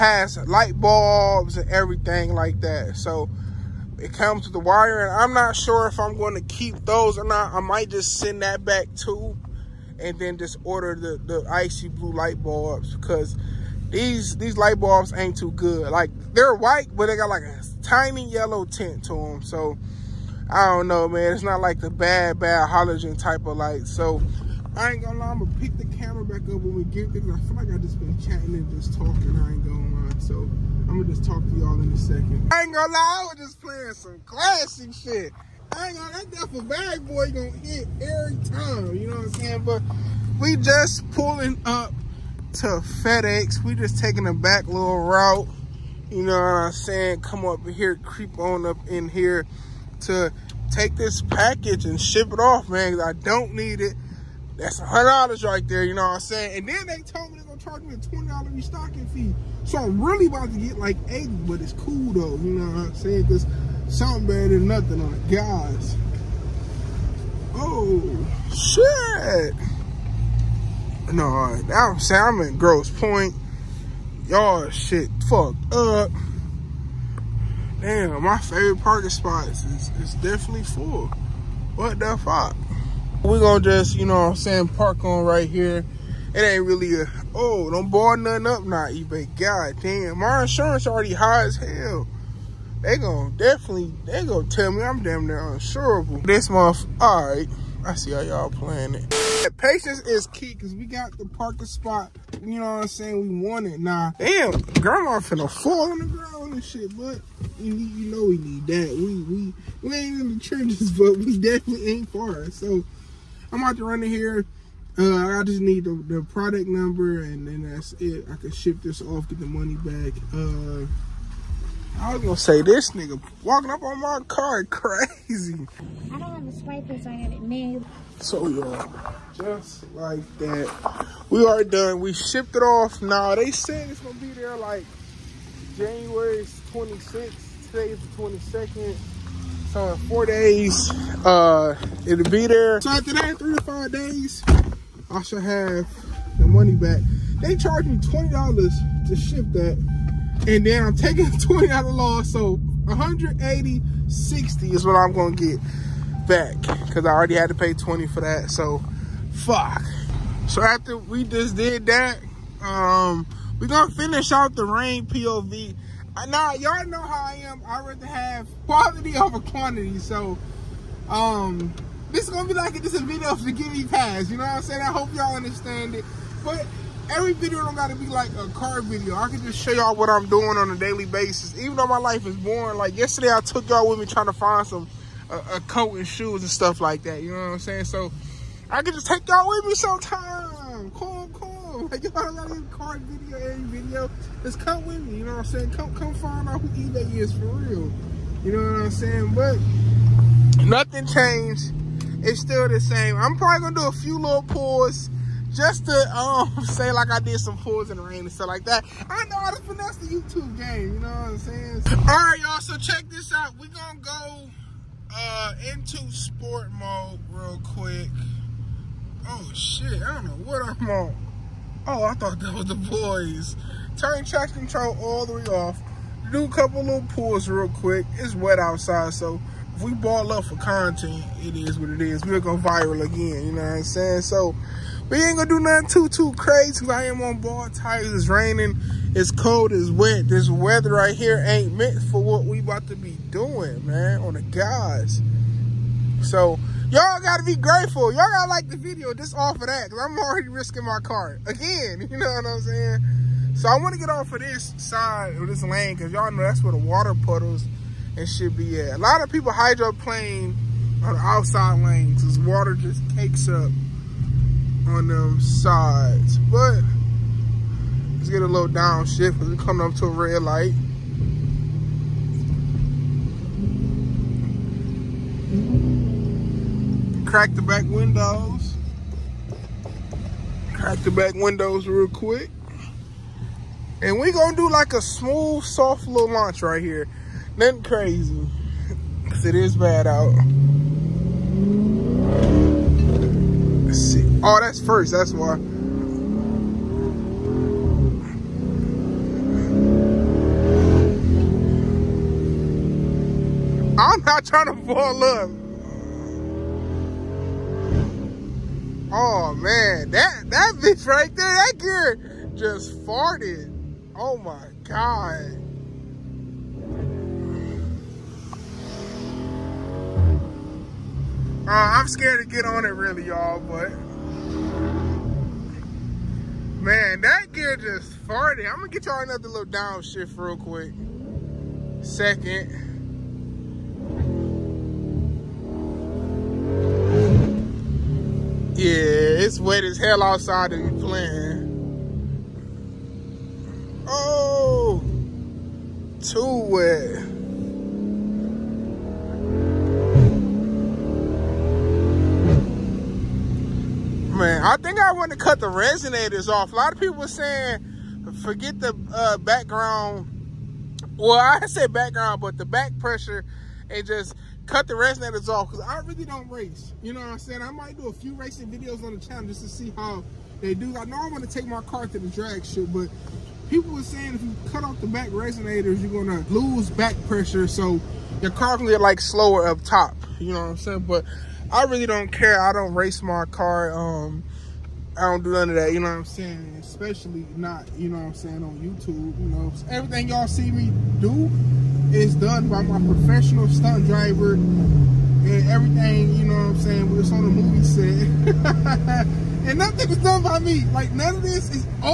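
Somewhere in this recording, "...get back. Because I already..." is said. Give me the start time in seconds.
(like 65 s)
155 s.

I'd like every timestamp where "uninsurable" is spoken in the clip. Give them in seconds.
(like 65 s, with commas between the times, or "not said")
95 s.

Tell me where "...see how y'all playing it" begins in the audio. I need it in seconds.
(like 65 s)
97 s.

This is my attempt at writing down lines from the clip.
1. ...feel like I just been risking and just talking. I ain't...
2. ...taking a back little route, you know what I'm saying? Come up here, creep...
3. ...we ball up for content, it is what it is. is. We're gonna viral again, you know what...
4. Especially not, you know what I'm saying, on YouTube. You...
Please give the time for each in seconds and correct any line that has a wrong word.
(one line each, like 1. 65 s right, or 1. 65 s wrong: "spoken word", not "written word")
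1. 27 s wrong: "chatting", not "risking"
2. 43 s right
3. 229 s right
4. 386 s right.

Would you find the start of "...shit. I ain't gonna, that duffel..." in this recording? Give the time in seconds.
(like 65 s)
34 s.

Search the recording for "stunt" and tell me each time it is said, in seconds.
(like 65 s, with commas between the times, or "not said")
393 s.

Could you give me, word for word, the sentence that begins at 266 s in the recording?
But let's get a little downshift because we're coming up to a red light.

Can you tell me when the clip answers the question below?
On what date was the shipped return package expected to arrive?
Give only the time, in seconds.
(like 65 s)
135 s.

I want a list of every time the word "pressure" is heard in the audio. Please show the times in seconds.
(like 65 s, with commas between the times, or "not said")
362 s, 377 s.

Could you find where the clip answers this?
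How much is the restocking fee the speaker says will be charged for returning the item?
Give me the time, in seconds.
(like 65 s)
57 s.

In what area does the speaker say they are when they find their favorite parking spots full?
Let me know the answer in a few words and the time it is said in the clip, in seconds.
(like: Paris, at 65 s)
Grosse Pointe, at 72 s.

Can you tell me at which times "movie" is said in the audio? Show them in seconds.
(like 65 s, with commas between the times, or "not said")
397 s.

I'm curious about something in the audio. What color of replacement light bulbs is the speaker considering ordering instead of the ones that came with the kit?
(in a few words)
icy blue.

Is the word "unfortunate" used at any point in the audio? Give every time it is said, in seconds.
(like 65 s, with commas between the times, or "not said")
not said.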